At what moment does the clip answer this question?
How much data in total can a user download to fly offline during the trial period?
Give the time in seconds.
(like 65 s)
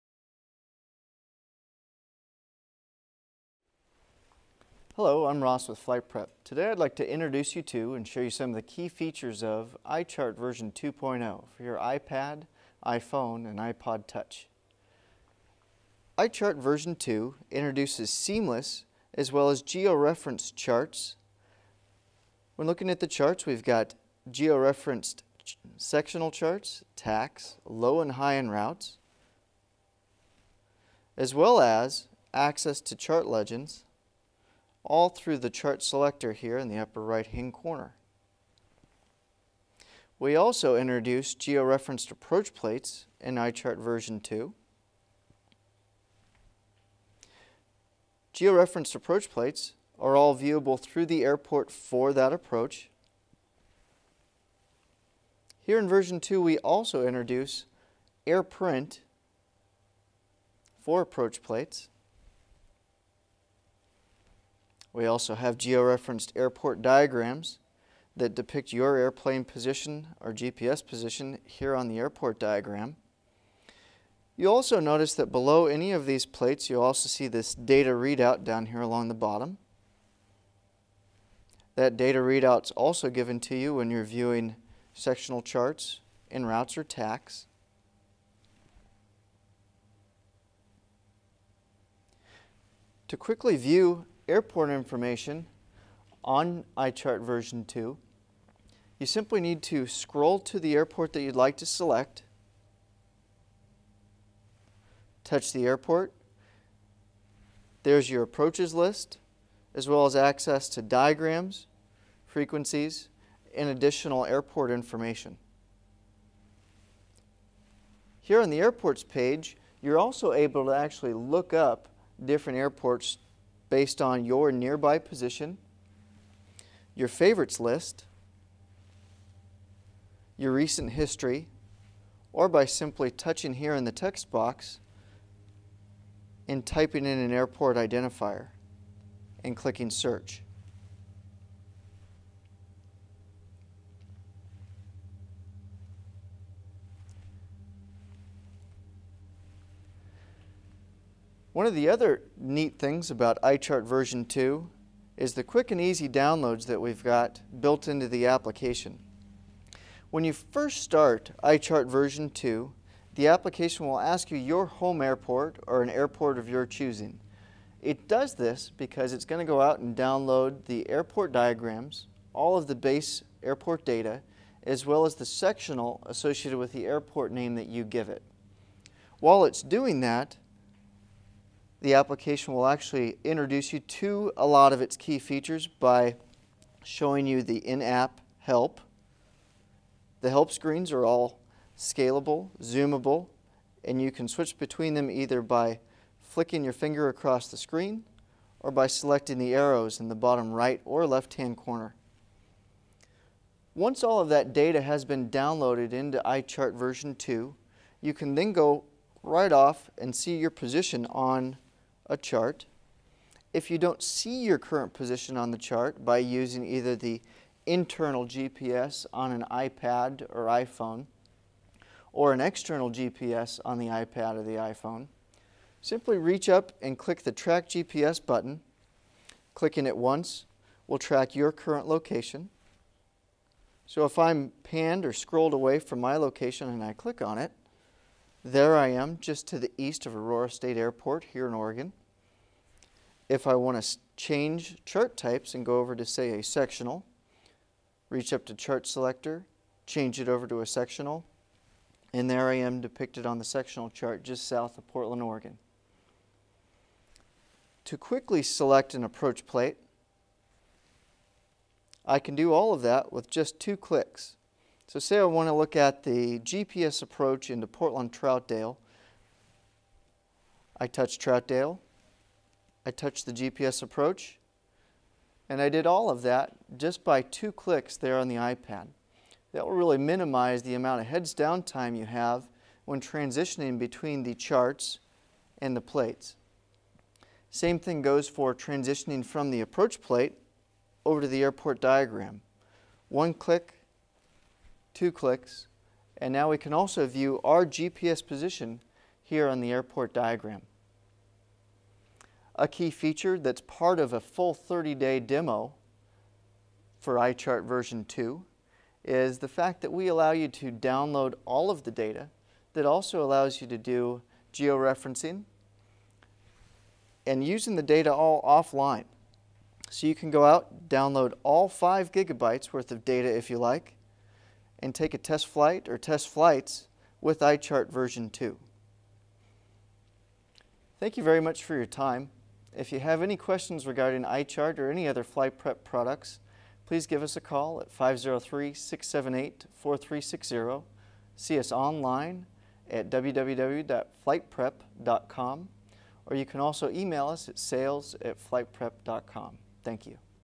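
321 s.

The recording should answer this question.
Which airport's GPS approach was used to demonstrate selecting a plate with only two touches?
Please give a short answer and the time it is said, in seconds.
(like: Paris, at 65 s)
Portland Troutdale, at 267 s.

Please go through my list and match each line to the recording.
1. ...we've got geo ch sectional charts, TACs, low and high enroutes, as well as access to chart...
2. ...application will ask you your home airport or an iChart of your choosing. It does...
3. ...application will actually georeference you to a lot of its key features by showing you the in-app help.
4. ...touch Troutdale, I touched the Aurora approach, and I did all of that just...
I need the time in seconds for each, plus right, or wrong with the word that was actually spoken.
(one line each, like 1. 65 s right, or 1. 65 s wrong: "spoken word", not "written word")
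1. 23 s right
2. 163 s wrong: "airport", not "iChart"
3. 181 s wrong: "introduce", not "georeference"
4. 270 s wrong: "GPS", not "Aurora".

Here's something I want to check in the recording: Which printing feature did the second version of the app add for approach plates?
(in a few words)
AirPrint.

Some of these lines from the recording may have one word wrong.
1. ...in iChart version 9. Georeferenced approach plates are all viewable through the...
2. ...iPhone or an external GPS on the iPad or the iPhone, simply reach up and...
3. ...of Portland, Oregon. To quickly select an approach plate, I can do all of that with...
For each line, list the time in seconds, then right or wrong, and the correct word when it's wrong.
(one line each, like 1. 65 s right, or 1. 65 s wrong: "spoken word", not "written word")
1. 43 s wrong: "2", not "9"
2. 220 s right
3. 254 s right.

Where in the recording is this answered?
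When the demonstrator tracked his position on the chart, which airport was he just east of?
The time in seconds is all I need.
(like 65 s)
240 s.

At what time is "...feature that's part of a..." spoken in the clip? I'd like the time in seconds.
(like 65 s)
302 s.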